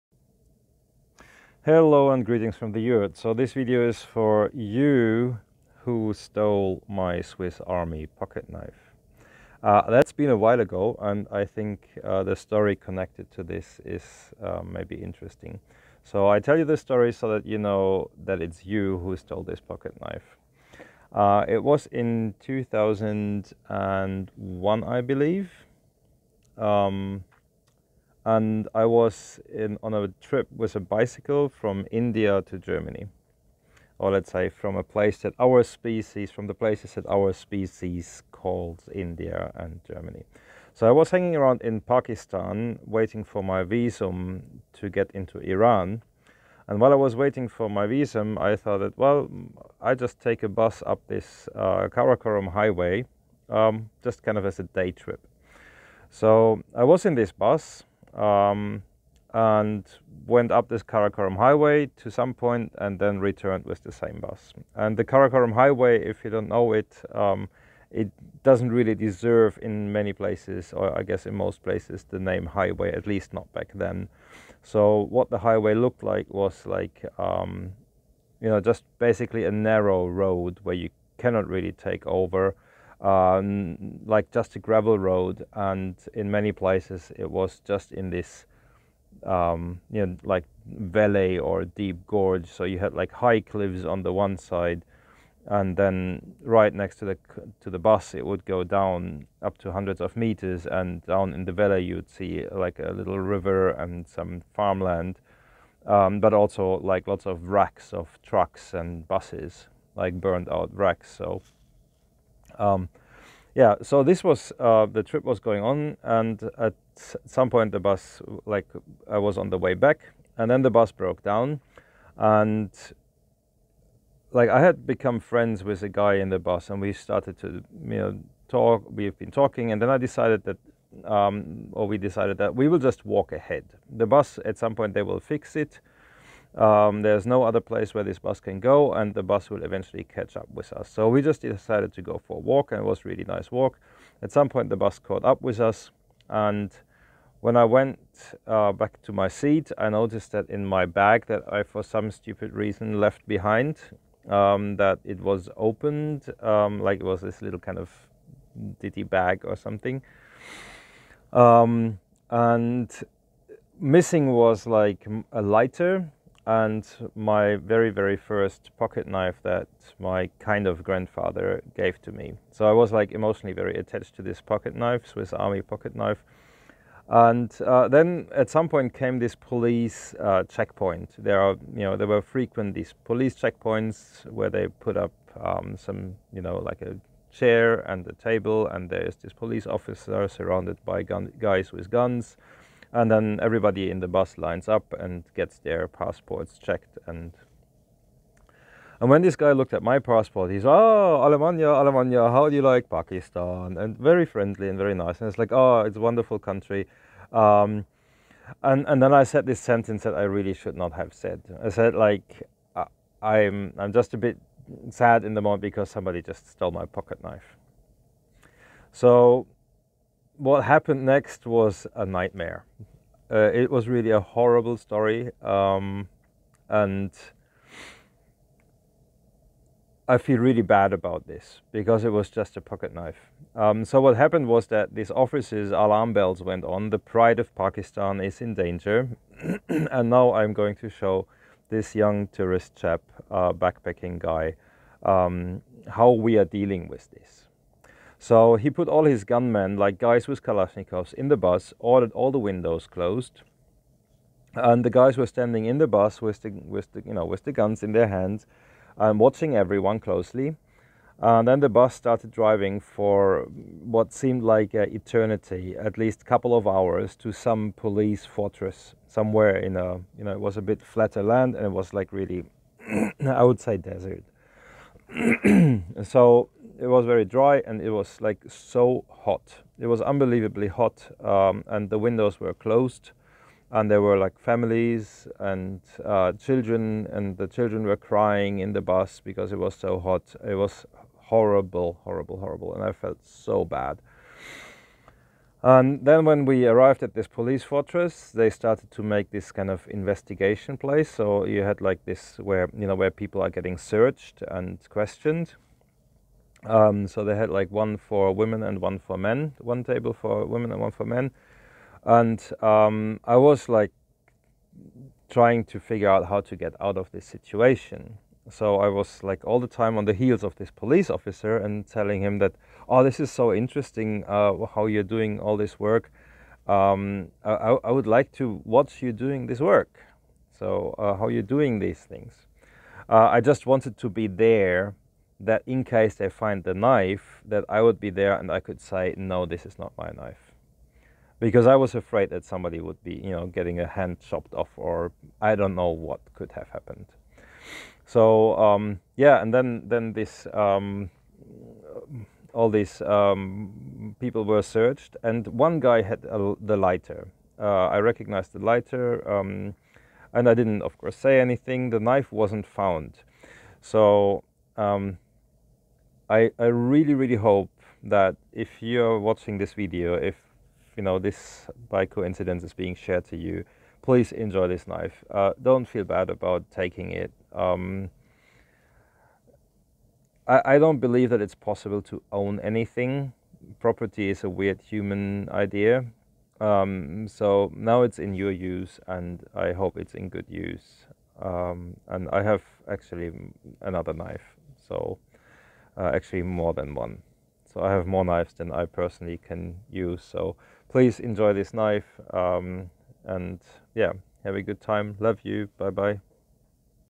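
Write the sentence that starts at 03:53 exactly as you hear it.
Um, so what happened was that these officers' alarm bells went on.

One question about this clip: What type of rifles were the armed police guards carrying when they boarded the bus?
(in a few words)
Kalashnikovs.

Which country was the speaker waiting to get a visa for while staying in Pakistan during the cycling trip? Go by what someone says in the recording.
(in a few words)
Iran.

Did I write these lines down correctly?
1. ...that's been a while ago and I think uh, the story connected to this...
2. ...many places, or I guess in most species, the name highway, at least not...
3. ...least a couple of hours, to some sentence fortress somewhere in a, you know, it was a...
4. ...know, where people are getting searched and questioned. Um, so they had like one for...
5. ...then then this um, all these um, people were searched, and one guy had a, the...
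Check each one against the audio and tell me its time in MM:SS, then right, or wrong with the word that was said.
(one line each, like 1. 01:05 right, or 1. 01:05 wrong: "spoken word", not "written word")
1. 00:09 right
2. 01:09 wrong: "places", not "species"
3. 04:25 wrong: "police", not "sentence"
4. 05:02 right
5. 05:49 right.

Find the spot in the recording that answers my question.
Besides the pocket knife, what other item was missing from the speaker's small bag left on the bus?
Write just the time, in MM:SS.
02:45.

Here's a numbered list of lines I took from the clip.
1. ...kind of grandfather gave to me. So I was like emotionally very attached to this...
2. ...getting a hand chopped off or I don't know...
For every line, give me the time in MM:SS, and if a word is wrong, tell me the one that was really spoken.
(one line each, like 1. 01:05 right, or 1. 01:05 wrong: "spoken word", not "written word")
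1. 02:50 right
2. 05:43 right.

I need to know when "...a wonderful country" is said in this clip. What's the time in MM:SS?
03:25.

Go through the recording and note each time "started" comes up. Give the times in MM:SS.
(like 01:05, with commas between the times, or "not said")
02:06, 04:21, 04:58.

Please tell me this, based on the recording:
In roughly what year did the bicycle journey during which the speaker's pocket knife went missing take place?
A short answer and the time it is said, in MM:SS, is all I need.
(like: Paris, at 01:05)
2001, at 00:22.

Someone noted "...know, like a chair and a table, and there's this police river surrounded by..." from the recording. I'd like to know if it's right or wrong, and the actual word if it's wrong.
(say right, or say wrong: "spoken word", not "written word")
wrong: "officer", not "river".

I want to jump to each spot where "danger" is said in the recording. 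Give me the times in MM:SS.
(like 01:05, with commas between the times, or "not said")
03:58.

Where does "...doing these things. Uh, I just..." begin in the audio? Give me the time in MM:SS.
05:31.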